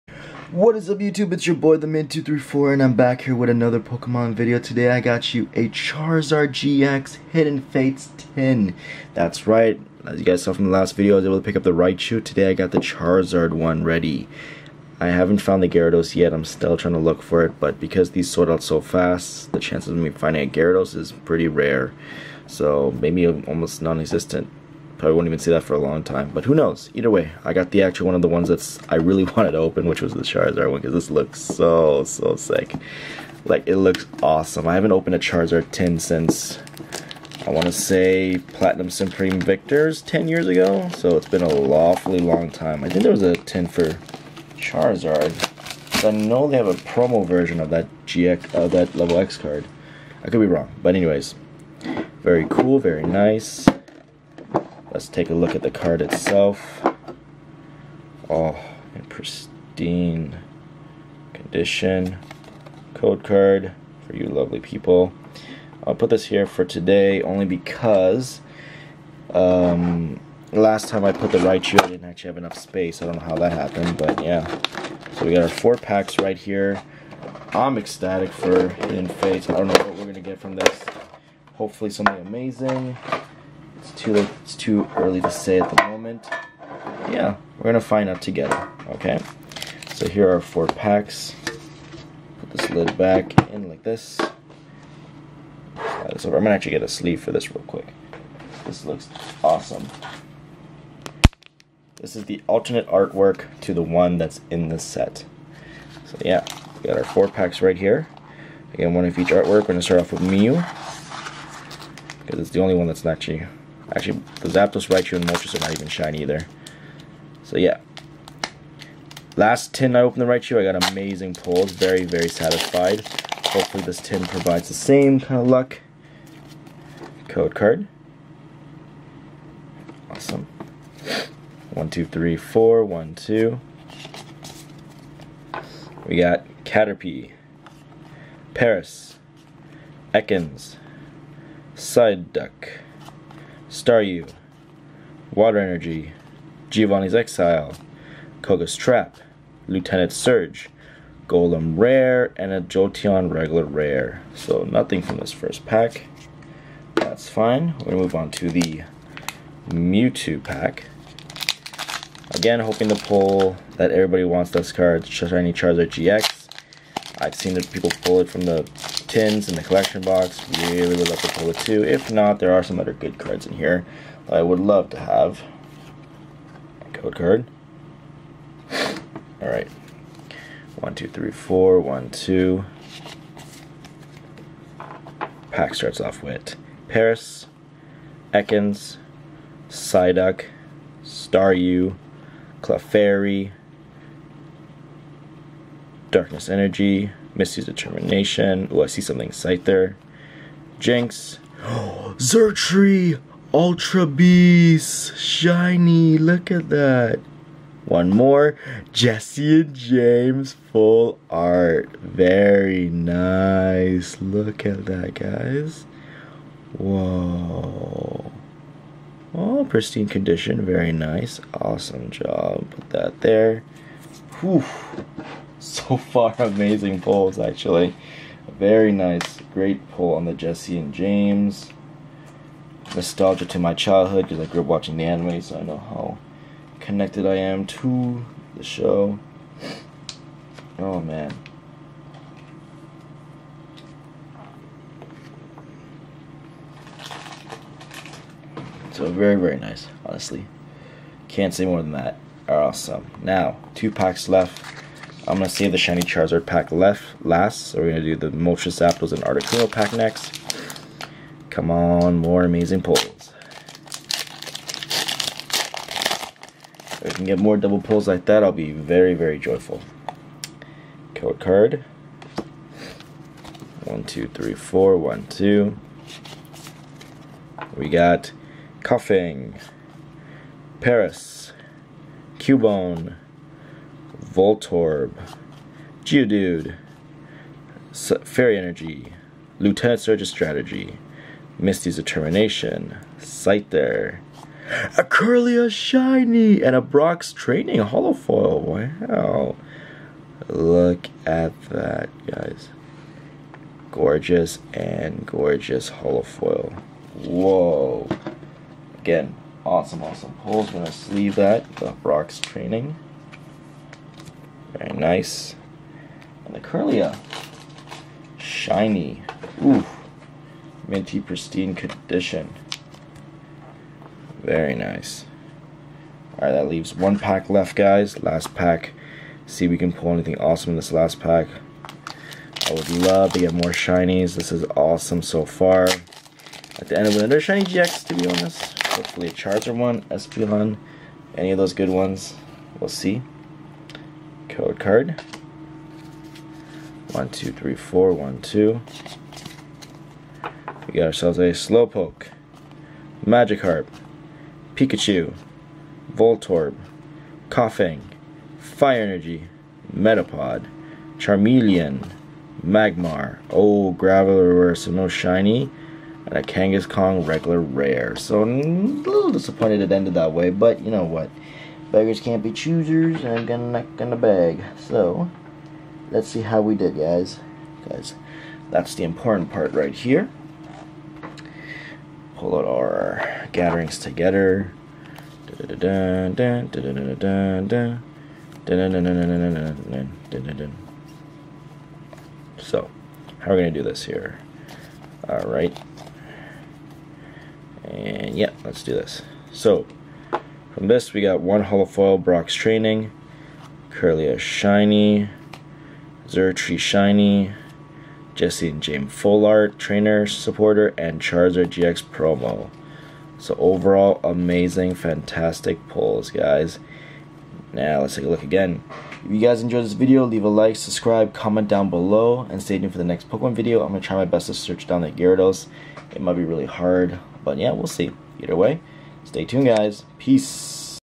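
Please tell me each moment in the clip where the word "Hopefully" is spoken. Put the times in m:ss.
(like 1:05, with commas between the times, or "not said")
1:21, 2:03, 5:38.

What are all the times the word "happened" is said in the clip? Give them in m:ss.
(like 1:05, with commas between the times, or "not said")
1:13.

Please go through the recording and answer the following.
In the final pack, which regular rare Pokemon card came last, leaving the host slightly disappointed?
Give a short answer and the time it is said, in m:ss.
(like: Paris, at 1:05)
Kangaskhan, at 6:06.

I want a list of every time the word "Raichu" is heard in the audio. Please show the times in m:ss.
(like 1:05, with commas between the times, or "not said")
0:11, 1:11, 1:54, 2:00.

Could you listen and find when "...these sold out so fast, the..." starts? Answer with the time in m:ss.
0:18.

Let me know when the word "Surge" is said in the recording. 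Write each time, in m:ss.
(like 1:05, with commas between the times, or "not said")
2:30, 4:49.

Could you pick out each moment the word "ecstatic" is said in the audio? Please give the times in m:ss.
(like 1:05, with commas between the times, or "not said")
1:17.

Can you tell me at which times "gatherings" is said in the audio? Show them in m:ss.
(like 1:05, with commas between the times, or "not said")
6:23.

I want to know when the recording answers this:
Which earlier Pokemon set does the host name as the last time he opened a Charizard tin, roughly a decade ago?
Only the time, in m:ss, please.
0:38.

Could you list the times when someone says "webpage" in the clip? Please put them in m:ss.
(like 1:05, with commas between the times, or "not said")
not said.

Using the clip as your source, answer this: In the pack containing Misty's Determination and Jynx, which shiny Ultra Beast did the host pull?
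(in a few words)
Xurkitree.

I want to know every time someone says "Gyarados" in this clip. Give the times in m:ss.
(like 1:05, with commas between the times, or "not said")
0:15, 0:20, 7:05.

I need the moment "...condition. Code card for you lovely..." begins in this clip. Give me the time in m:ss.
1:01.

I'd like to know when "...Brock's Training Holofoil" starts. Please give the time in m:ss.
4:56.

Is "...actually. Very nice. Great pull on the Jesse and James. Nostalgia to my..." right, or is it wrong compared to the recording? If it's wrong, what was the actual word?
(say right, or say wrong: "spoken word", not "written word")
right.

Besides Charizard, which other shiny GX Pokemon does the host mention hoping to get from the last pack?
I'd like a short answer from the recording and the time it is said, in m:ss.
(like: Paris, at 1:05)
Espeon, at 5:40.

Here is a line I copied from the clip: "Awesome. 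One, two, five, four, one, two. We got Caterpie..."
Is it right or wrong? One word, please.
wrong.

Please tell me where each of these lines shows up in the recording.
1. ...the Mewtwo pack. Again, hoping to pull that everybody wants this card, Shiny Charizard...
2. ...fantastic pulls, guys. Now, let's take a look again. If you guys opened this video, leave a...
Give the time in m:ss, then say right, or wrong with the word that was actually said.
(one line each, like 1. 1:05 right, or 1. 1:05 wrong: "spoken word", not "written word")
1. 2:38 right
2. 6:54 wrong: "enjoyed", not "opened".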